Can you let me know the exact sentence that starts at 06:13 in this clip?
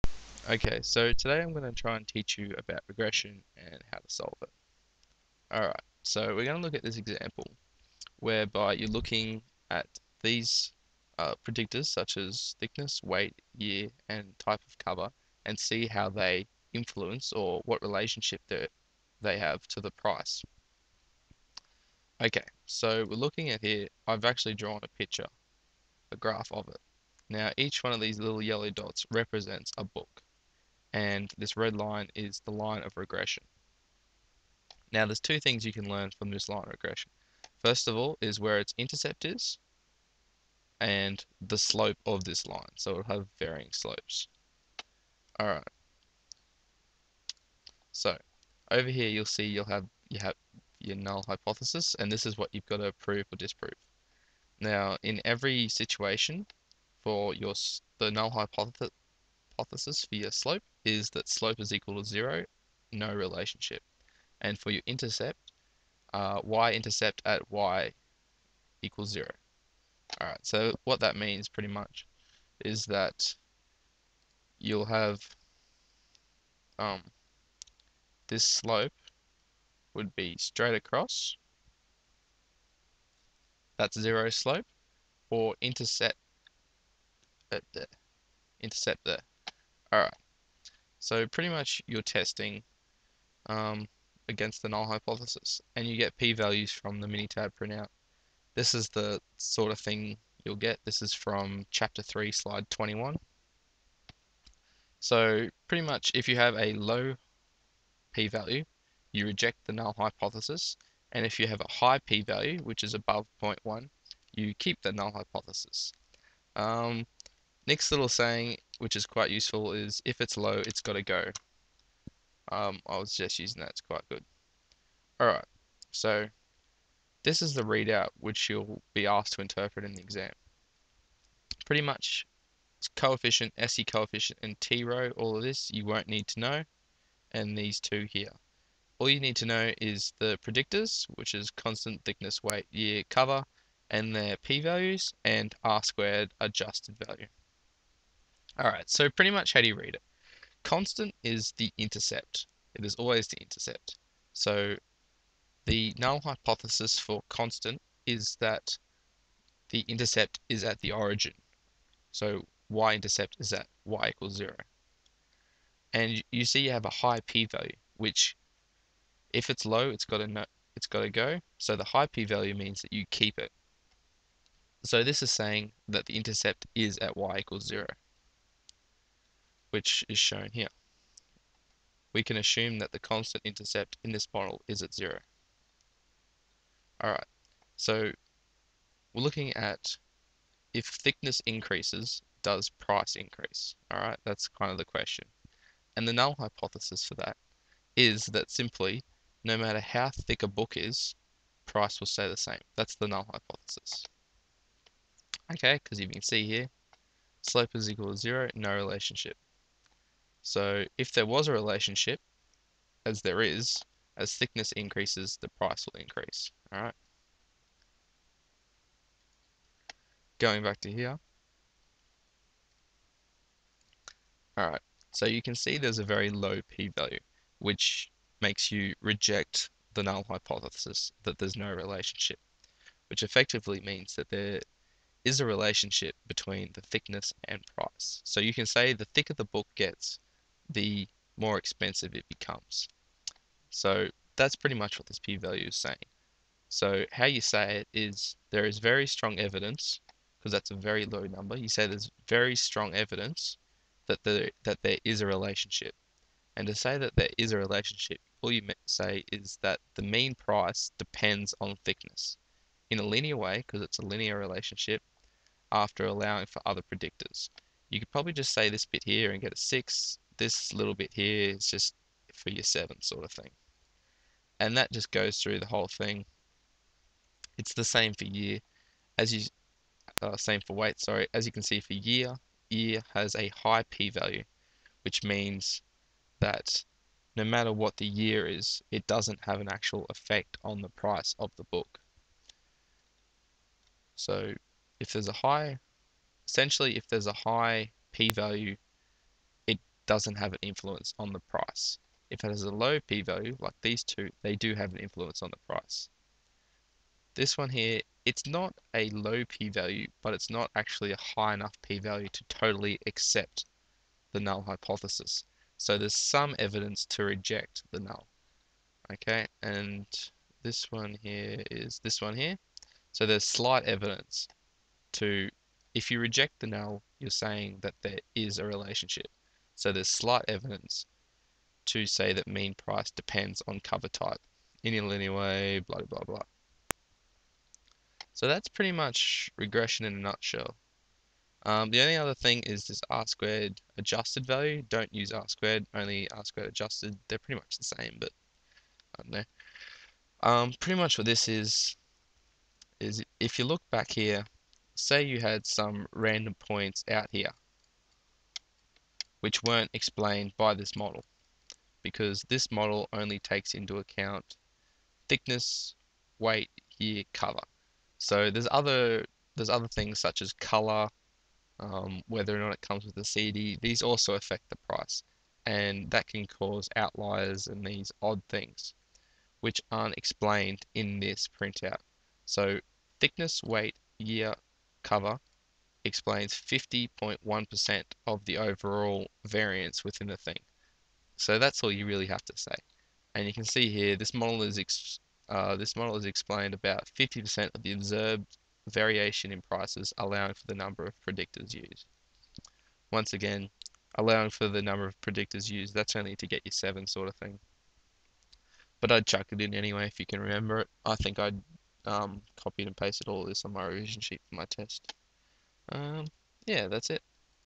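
These also affect the price, and that can cause outliers and these odd things, which aren't explained in this printout.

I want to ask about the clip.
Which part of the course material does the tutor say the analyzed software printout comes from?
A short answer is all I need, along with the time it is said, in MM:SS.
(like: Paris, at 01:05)
chapter 3 slide 21, at 01:41.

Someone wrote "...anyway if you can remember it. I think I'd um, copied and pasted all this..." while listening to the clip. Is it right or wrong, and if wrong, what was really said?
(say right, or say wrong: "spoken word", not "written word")
right.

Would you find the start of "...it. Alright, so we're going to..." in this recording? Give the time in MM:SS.
00:04.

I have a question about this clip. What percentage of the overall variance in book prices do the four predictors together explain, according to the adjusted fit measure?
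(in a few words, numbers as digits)
50.1%.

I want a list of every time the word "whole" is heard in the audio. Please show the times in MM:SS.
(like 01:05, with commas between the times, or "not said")
04:35.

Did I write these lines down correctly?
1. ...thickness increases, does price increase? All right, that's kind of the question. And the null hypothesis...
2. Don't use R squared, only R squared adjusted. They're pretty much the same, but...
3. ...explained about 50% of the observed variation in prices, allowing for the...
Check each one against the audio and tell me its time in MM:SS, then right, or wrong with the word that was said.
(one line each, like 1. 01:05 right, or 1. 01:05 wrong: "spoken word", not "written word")
1. 03:10 right
2. 05:44 right
3. 06:36 right.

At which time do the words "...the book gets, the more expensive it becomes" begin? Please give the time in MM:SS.
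03:59.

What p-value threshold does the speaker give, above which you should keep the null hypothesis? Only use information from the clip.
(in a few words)
0.1.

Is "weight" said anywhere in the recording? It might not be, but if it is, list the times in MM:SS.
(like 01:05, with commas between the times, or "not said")
00:13, 02:22, 04:40, 06:06, 06:23.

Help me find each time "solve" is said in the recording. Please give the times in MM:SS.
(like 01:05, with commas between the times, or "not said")
00:04.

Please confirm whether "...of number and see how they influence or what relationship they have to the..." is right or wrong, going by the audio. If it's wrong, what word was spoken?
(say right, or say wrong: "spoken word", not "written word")
wrong: "cover", not "number".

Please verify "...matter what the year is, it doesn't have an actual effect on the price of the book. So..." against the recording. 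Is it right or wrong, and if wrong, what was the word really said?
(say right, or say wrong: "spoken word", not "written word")
right.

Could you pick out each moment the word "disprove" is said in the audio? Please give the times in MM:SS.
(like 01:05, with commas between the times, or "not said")
00:53.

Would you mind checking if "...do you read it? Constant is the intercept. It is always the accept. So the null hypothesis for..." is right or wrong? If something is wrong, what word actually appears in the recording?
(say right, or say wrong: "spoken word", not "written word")
wrong: "intercept", not "accept".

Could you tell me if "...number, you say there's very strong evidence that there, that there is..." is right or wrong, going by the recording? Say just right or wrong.
right.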